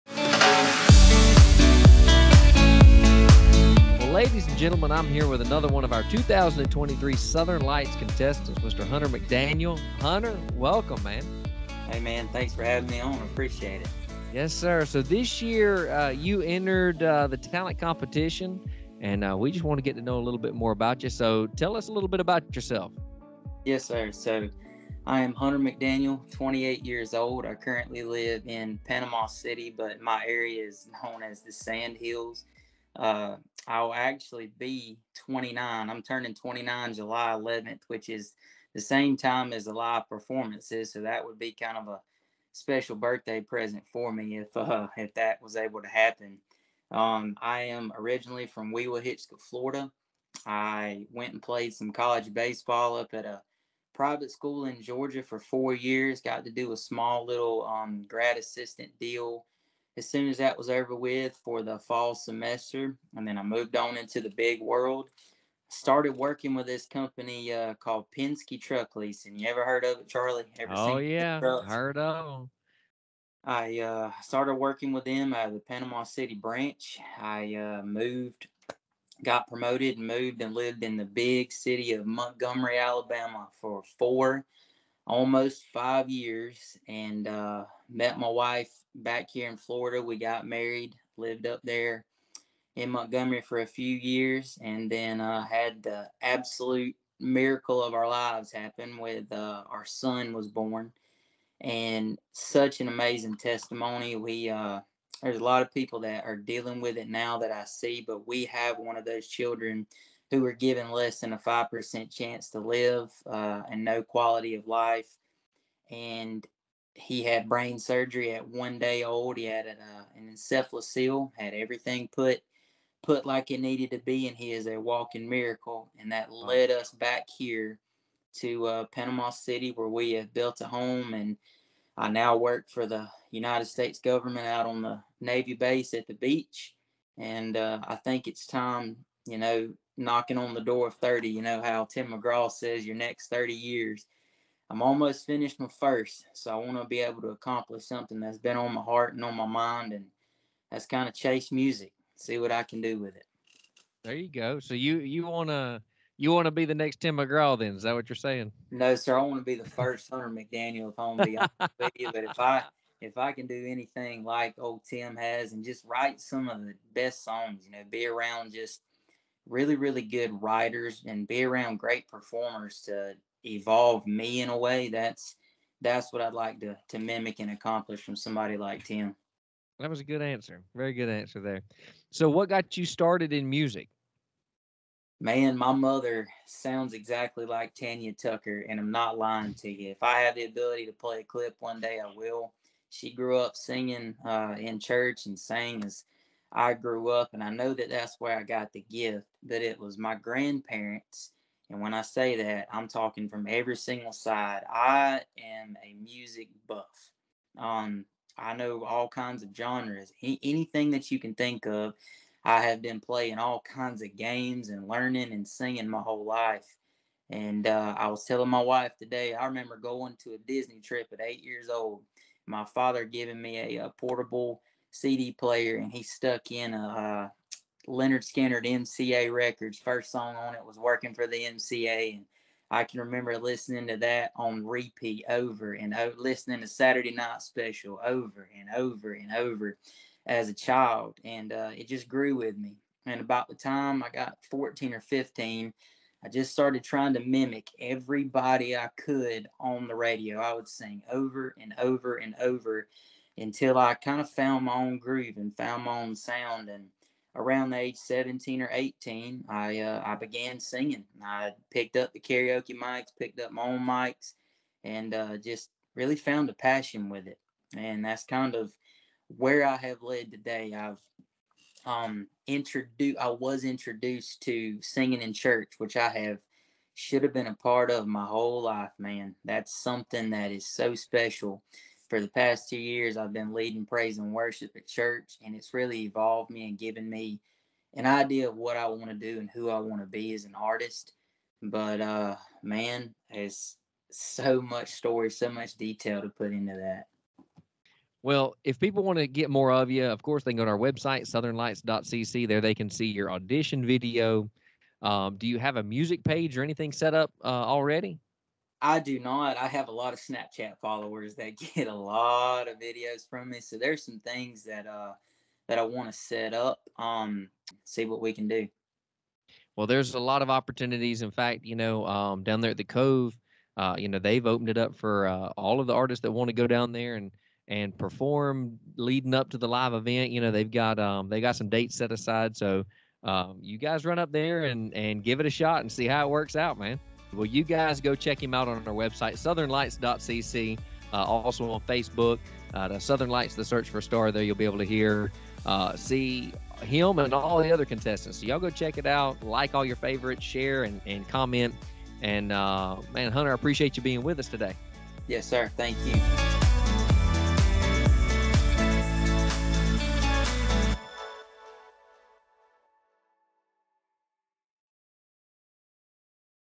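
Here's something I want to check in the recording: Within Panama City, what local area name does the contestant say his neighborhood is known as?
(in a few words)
Sand Hills.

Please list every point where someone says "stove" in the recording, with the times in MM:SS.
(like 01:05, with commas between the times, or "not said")
not said.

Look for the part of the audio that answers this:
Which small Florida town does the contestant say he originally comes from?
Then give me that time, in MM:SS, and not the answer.
00:48.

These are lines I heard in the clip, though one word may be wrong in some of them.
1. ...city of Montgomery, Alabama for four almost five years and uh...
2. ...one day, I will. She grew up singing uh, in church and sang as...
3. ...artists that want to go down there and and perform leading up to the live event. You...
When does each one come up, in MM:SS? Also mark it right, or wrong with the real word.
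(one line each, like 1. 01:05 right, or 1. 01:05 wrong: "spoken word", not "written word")
1. 01:21 right
2. 03:11 right
3. 05:25 right.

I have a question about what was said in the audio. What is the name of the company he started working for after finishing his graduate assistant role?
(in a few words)
Penske Truck Leasing.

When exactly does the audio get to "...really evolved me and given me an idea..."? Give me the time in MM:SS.
04:45.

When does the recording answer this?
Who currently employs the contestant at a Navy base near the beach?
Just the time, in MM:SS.
02:13.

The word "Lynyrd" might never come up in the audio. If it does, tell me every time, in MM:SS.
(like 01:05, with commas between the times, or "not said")
03:47.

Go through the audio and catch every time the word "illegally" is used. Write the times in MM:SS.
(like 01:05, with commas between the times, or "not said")
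not said.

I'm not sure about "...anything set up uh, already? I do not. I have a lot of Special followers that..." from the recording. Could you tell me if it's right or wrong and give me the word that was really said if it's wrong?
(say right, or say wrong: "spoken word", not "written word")
wrong: "Snapchat", not "Special".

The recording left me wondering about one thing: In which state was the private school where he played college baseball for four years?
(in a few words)
Georgia.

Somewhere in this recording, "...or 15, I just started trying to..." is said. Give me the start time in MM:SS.
04:04.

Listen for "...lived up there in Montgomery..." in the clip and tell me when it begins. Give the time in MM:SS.
01:31.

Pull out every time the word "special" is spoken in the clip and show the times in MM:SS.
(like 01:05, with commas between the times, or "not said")
00:42, 03:57, 04:40.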